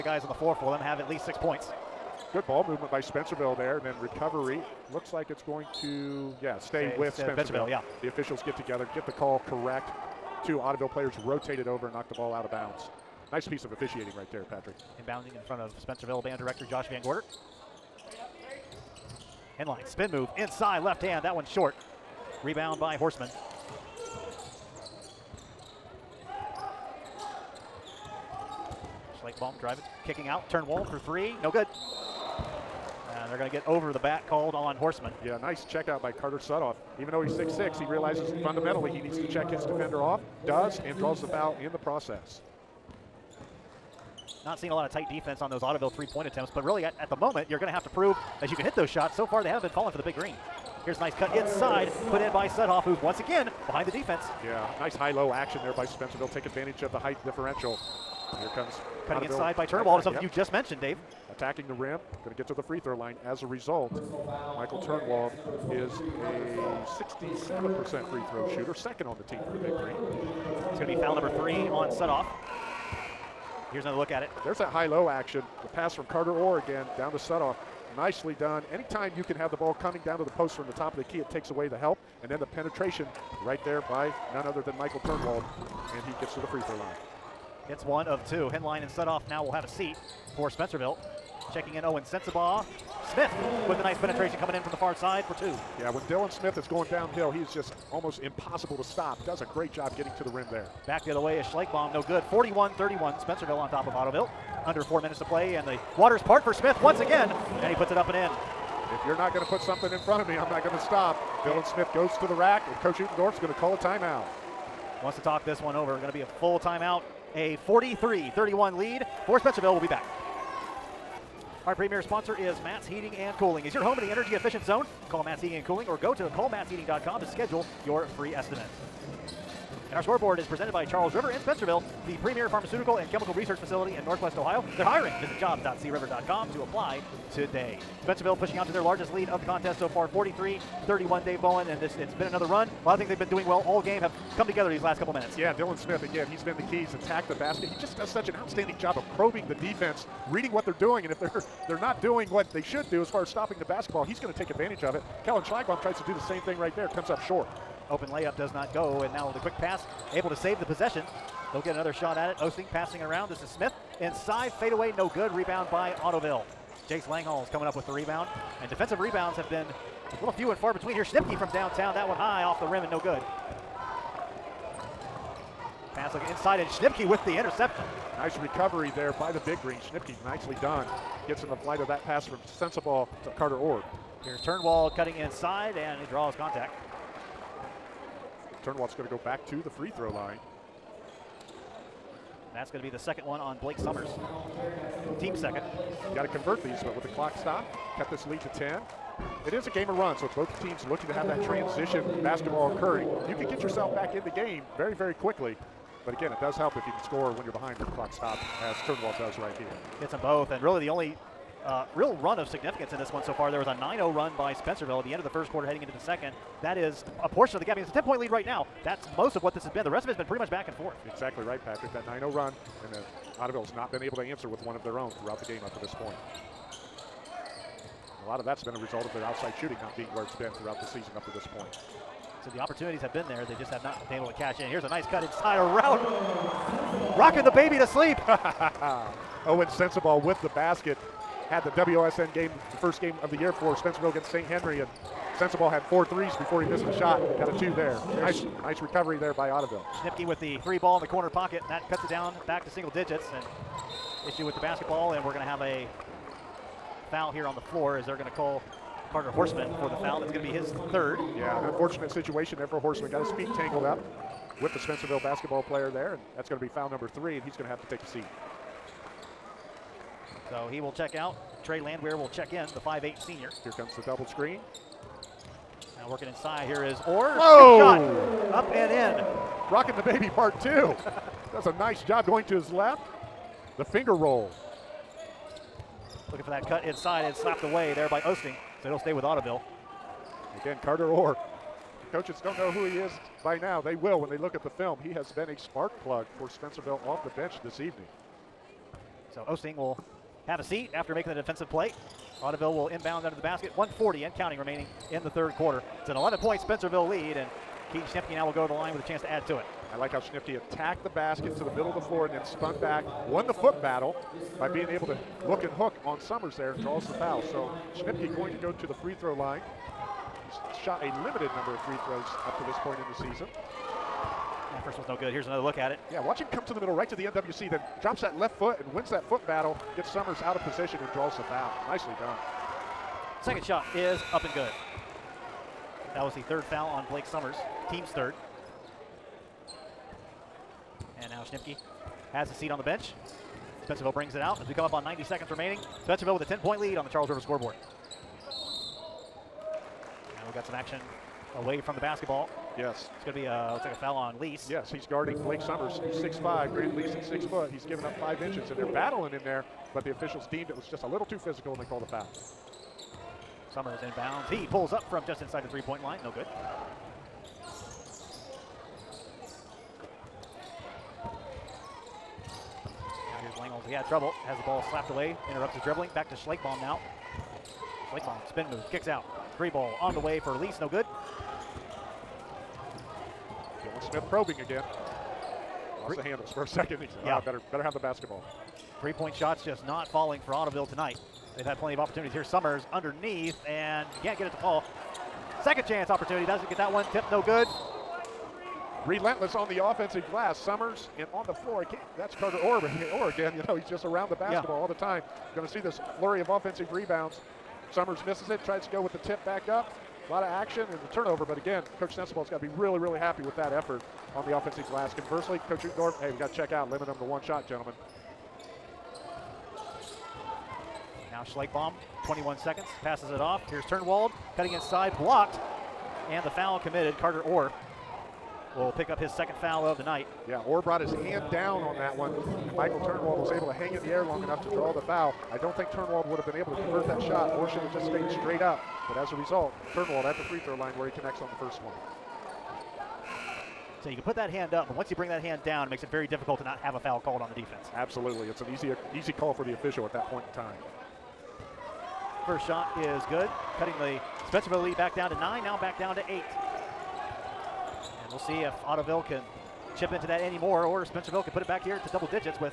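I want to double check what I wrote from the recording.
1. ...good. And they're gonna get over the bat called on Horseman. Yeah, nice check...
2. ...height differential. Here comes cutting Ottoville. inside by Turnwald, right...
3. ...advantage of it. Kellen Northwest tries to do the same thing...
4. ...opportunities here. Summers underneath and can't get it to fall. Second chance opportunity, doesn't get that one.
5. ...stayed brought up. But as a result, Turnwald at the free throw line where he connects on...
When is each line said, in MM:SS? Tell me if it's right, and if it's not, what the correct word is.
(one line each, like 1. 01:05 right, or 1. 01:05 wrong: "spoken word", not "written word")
1. 00:31 right
2. 00:56 right
3. 02:34 wrong: "Schlagbaum", not "Northwest"
4. 06:31 right
5. 07:18 wrong: "straight", not "brought".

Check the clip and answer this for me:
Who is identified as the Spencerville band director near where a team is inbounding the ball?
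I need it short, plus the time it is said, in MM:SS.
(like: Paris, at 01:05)
Josh Van Gorder, at 00:16.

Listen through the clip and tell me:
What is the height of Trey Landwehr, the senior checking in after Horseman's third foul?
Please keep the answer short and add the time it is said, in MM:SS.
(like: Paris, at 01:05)
5'8, at 04:32.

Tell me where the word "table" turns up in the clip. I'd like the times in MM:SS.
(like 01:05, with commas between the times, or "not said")
not said.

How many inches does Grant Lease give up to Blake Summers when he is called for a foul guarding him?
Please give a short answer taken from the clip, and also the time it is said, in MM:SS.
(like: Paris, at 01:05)
5, at 05:58.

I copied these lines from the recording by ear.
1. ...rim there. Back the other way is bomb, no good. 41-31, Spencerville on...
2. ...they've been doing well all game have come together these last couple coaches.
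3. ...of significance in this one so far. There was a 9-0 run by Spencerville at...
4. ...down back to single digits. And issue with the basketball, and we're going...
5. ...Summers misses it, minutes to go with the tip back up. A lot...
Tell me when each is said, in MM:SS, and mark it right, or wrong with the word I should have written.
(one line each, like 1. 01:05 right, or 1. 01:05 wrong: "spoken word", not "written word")
1. 01:40 right
2. 02:23 wrong: "minutes", not "coaches"
3. 03:32 right
4. 04:12 right
5. 06:47 wrong: "tries", not "minutes".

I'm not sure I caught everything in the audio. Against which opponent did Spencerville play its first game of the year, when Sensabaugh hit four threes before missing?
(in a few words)
St. Henry.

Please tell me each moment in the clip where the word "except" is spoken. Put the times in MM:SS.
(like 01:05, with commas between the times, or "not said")
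not said.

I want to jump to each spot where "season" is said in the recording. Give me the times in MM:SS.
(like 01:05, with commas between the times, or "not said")
03:50, 05:23.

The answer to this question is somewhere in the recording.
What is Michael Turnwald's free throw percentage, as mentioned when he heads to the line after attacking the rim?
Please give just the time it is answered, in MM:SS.
01:06.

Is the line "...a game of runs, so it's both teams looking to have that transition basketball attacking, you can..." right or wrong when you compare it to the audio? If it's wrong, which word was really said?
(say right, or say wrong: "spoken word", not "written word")
wrong: "occurring", not "attacking".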